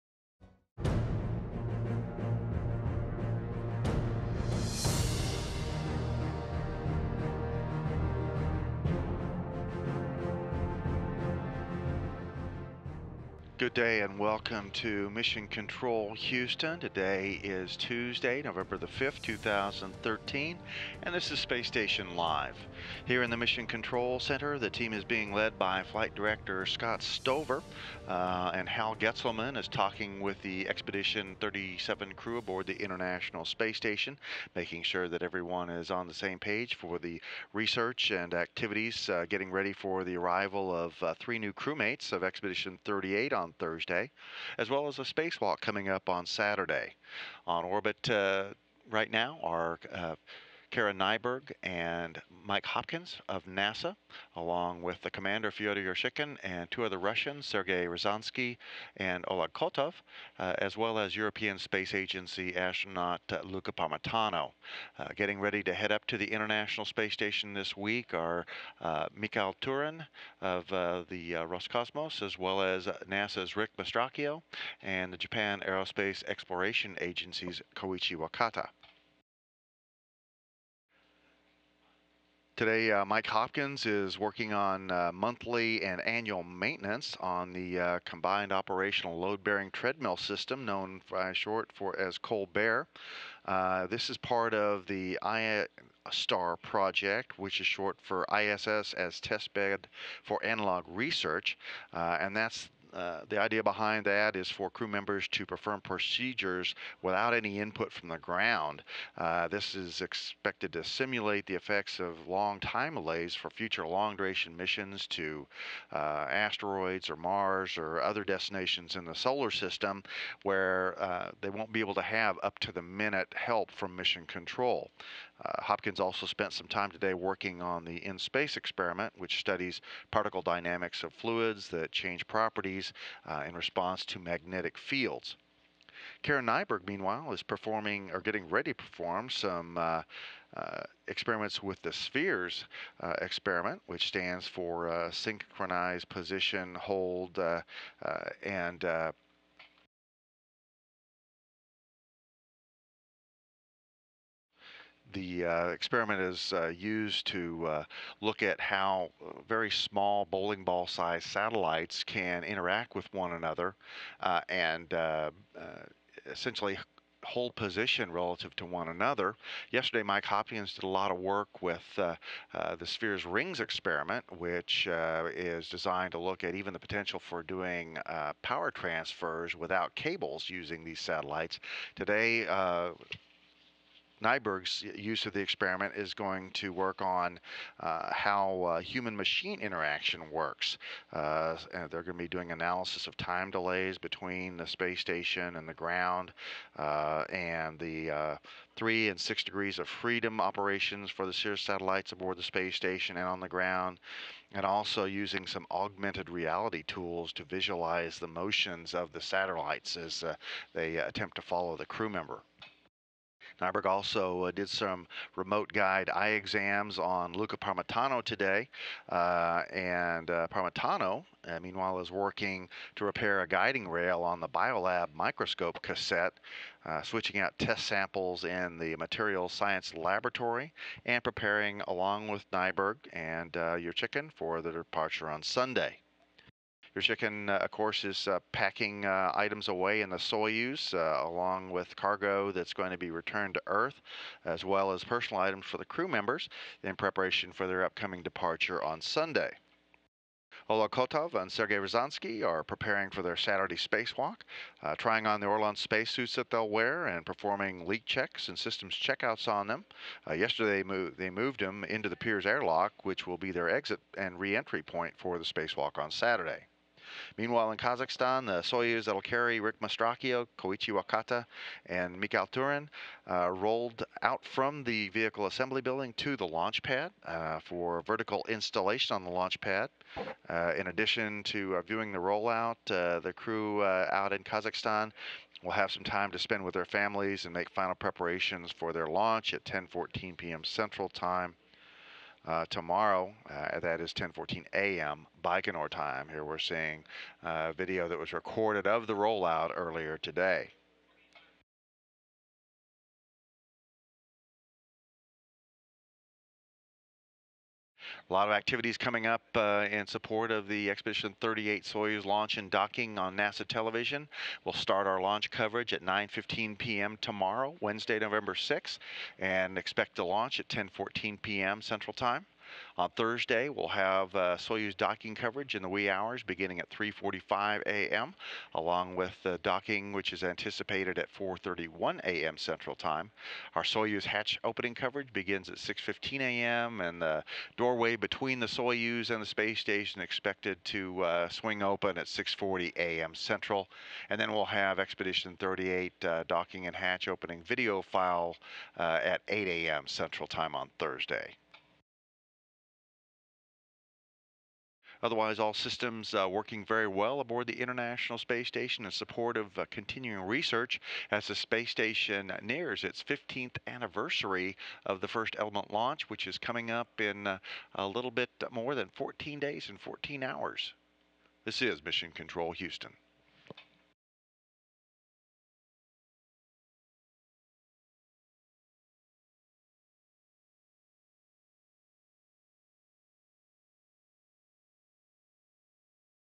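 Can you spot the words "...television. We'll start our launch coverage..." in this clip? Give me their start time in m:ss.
5:13.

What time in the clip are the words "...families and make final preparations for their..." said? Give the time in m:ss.
4:46.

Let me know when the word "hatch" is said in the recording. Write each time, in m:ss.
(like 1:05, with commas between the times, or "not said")
5:34, 5:46.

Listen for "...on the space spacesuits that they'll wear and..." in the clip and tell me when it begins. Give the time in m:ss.
4:15.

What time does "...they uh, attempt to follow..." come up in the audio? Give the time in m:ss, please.
3:30.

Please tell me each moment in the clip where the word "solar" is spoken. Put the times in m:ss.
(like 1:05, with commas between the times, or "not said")
1:59.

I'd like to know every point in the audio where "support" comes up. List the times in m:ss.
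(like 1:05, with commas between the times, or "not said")
5:10, 5:59.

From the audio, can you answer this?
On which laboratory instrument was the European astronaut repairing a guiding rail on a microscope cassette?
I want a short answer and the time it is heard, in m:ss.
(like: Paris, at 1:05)
Biolab, at 3:44.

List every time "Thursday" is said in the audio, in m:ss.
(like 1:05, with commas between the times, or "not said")
0:43, 5:23, 5:50.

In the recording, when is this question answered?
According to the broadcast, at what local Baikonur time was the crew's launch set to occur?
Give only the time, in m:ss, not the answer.
4:54.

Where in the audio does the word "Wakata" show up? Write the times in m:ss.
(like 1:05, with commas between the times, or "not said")
1:18, 4:30.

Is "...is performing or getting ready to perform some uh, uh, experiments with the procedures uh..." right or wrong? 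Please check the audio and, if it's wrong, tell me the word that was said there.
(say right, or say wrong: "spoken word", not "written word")
wrong: "spheres", not "procedures".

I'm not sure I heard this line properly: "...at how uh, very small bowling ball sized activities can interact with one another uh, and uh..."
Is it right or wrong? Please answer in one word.
wrong.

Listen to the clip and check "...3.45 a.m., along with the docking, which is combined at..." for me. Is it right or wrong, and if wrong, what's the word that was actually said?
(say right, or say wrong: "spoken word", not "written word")
wrong: "anticipated", not "combined".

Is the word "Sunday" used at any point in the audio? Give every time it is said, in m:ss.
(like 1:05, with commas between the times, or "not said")
3:55, 4:08.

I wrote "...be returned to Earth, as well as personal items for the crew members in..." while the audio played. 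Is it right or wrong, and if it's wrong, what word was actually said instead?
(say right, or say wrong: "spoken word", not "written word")
right.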